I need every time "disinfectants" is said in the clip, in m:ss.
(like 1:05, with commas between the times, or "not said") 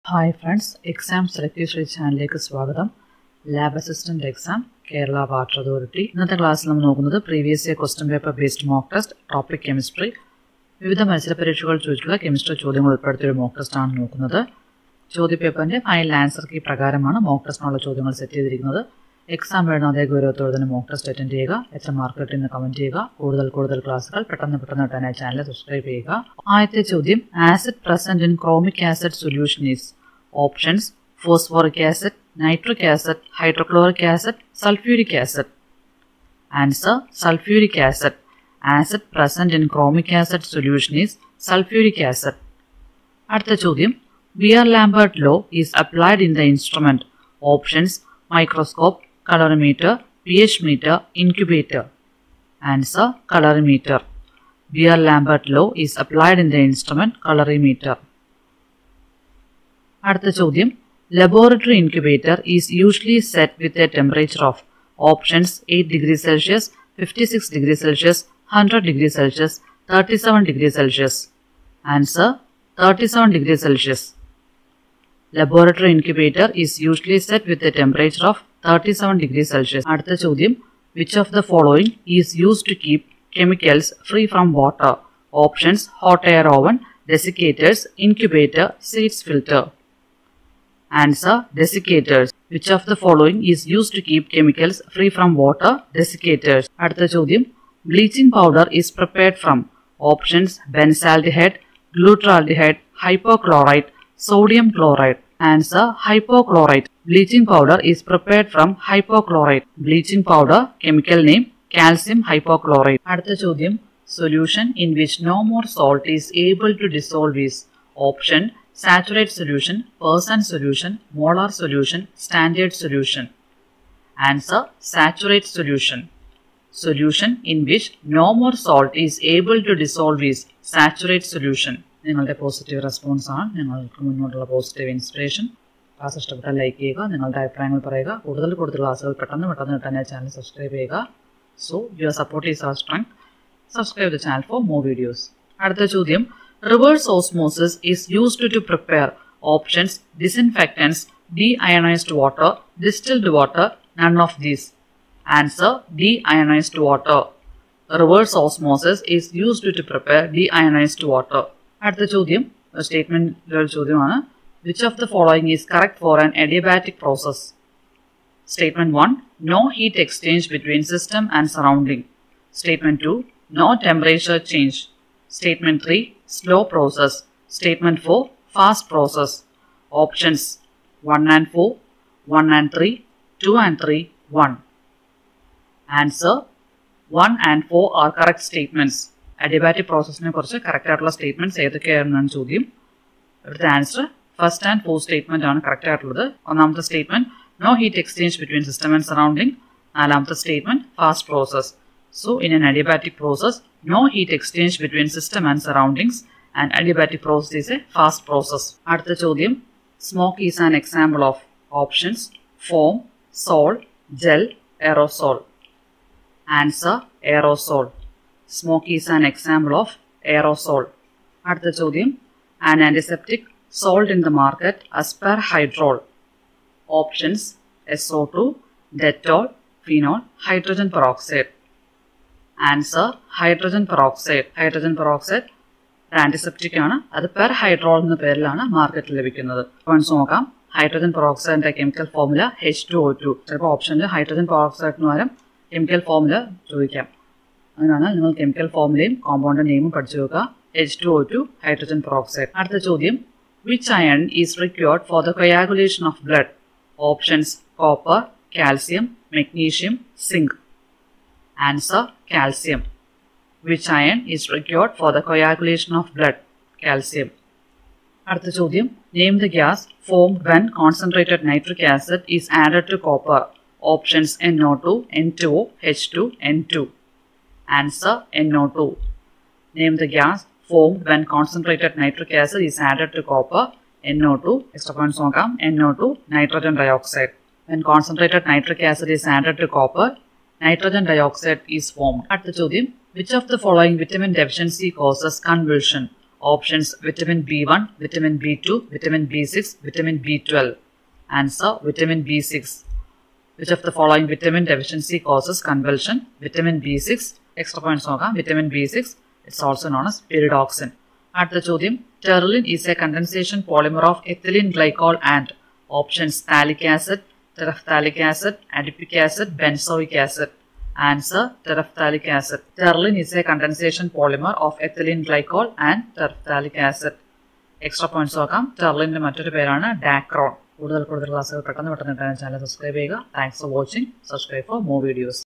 2:30.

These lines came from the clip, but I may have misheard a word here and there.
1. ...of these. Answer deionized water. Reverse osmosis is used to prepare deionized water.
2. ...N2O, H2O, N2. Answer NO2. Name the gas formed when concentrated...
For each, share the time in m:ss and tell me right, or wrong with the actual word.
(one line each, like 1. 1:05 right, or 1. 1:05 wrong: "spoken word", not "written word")
1. 2:34 right
2. 4:35 right.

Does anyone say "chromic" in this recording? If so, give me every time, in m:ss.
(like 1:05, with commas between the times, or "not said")
0:39.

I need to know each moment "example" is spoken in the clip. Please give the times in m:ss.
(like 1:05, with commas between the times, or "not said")
3:30, 3:39.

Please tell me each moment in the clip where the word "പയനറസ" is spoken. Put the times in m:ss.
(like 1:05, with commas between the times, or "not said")
5:07, 5:28.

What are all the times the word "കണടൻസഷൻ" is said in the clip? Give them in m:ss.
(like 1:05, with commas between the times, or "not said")
5:13.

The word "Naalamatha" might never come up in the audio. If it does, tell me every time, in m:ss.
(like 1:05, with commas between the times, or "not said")
3:19.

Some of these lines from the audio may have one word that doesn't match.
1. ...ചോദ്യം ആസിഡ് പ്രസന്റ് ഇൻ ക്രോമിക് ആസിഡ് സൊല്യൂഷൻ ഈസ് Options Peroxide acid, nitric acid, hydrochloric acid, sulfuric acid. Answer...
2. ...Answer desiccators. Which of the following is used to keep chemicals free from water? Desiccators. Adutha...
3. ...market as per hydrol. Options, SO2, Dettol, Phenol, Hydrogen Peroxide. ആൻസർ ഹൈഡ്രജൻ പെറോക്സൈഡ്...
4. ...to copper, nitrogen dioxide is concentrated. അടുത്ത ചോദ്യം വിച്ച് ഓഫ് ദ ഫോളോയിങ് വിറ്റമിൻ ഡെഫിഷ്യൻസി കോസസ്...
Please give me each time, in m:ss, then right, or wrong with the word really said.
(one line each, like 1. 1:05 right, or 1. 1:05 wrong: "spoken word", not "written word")
1. 0:26 wrong: "Phosphoric", not "Peroxide"
2. 1:30 right
3. 3:44 right
4. 4:49 wrong: "formed", not "concentrated".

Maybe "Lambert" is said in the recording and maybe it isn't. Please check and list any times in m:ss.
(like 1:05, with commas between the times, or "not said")
0:44, 0:54.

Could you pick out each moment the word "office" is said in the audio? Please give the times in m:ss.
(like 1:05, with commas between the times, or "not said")
not said.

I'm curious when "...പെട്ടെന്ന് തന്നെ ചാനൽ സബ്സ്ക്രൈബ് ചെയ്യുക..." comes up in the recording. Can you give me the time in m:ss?
2:19.